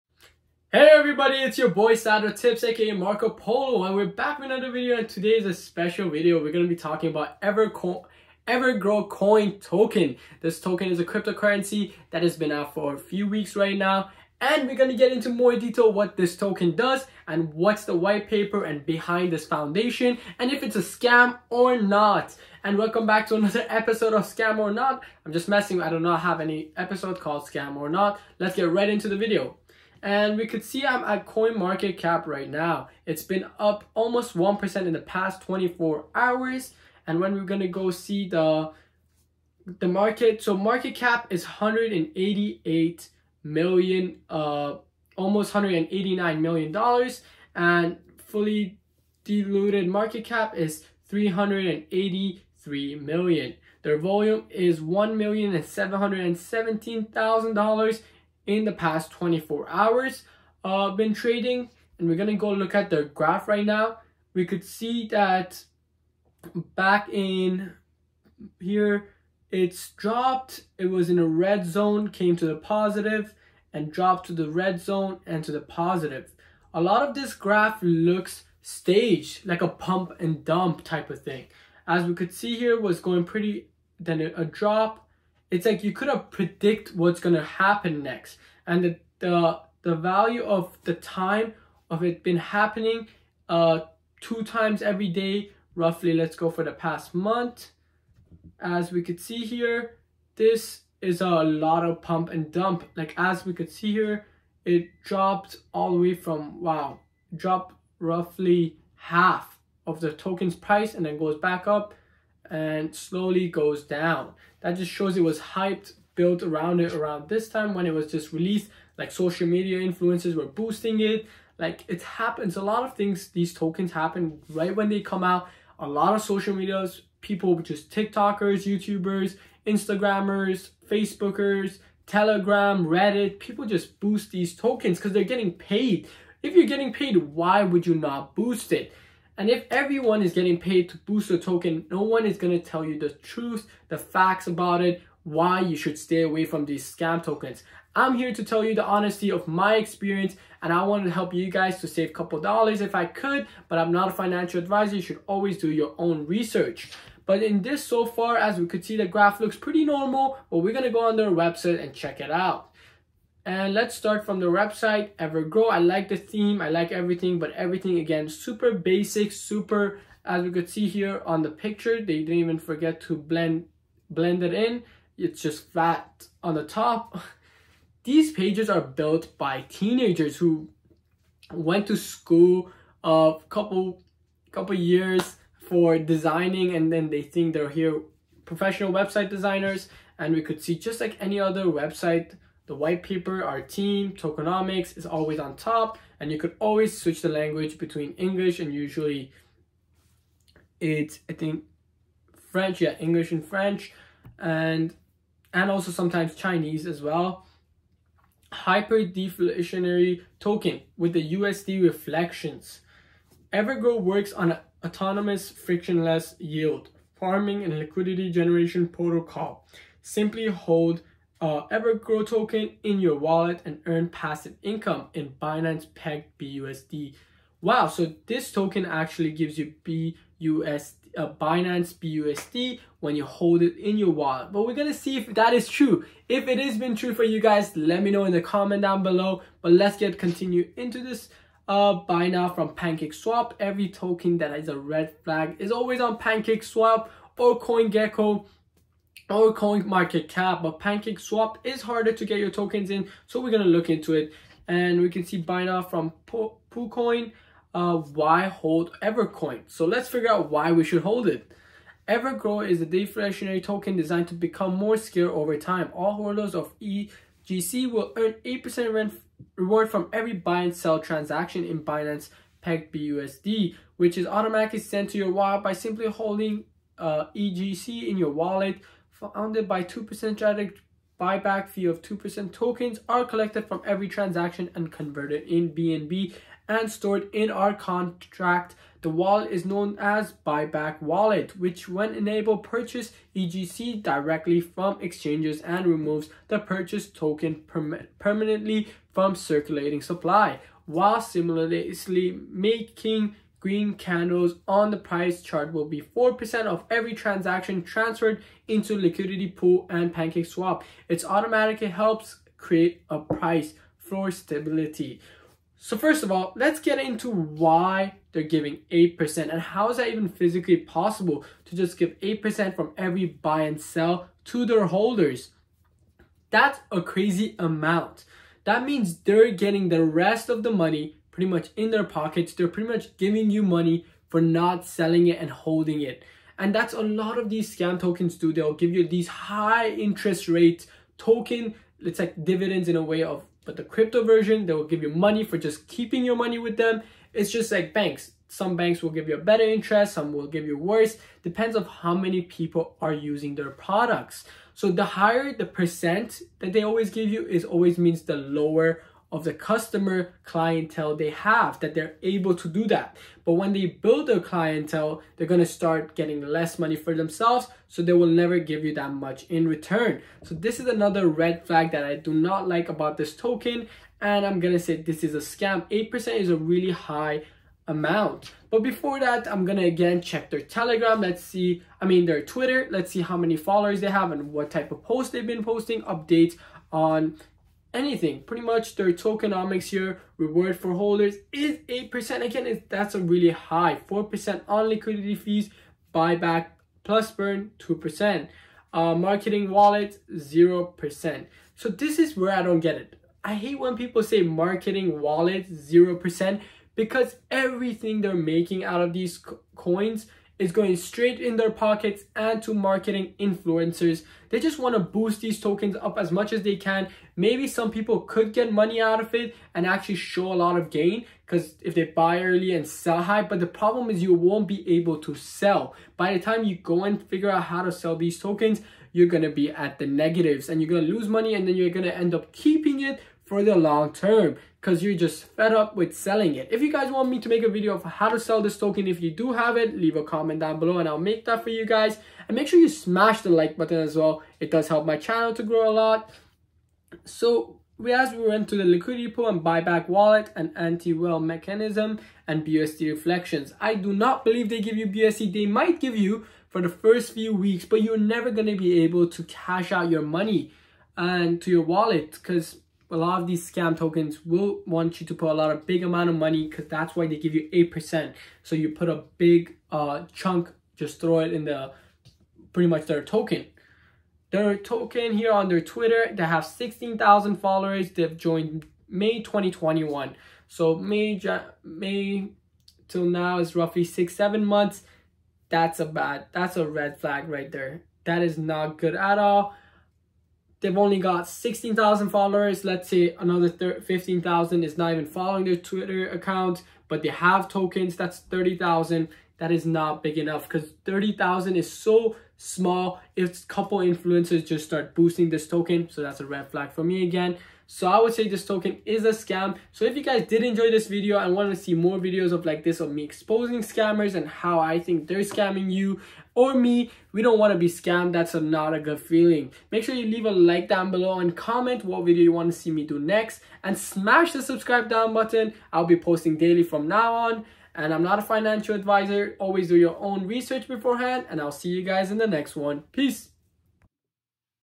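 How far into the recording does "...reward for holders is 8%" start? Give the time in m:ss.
6:30.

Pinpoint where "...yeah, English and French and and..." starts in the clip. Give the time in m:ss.
3:22.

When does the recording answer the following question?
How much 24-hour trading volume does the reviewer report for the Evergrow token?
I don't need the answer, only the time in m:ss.
0:54.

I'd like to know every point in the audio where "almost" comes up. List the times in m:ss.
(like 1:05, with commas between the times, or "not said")
0:33, 0:45.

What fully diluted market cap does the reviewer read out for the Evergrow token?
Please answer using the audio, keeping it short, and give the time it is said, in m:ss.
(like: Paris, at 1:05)
383 million, at 0:51.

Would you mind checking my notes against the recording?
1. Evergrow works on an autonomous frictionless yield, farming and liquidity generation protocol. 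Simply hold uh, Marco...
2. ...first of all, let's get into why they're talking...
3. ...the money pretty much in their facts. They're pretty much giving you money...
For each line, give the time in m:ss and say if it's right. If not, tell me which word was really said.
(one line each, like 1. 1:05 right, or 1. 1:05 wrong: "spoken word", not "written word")
1. 3:33 wrong: "Evergrow", not "Marco"
2. 5:15 wrong: "giving", not "talking"
3. 5:30 wrong: "pockets", not "facts".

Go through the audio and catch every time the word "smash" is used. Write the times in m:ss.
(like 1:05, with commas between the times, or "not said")
7:22, 8:43.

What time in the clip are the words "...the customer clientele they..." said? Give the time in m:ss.
5:59.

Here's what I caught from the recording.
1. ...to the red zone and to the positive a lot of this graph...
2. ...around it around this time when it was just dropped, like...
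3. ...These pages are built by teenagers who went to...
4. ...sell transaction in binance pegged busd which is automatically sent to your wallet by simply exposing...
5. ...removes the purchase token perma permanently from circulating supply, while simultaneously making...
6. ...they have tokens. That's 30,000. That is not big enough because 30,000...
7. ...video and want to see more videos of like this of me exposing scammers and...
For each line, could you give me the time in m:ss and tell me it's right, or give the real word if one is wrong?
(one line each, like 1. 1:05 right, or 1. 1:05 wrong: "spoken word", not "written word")
1. 1:14 right
2. 1:56 wrong: "released", not "dropped"
3. 2:58 right
4. 4:30 wrong: "holding", not "exposing"
5. 4:55 right
6. 8:17 right
7. 8:31 right.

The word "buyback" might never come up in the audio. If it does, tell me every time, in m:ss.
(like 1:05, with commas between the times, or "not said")
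4:41, 4:50, 6:36, 7:29.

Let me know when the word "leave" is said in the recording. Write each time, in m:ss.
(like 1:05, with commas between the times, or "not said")
7:19, 8:40.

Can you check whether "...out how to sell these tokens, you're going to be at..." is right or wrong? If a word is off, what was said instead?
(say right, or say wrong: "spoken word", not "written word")
right.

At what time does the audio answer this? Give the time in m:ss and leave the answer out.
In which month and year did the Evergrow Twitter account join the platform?
7:59.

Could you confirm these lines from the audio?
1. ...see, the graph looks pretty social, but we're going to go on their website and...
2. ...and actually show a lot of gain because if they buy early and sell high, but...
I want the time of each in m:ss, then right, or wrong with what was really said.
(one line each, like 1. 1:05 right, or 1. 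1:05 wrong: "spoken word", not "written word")
1. 2:38 wrong: "normal", not "social"
2. 6:59 right.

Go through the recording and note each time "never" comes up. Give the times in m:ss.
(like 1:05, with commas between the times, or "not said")
6:08, 7:38.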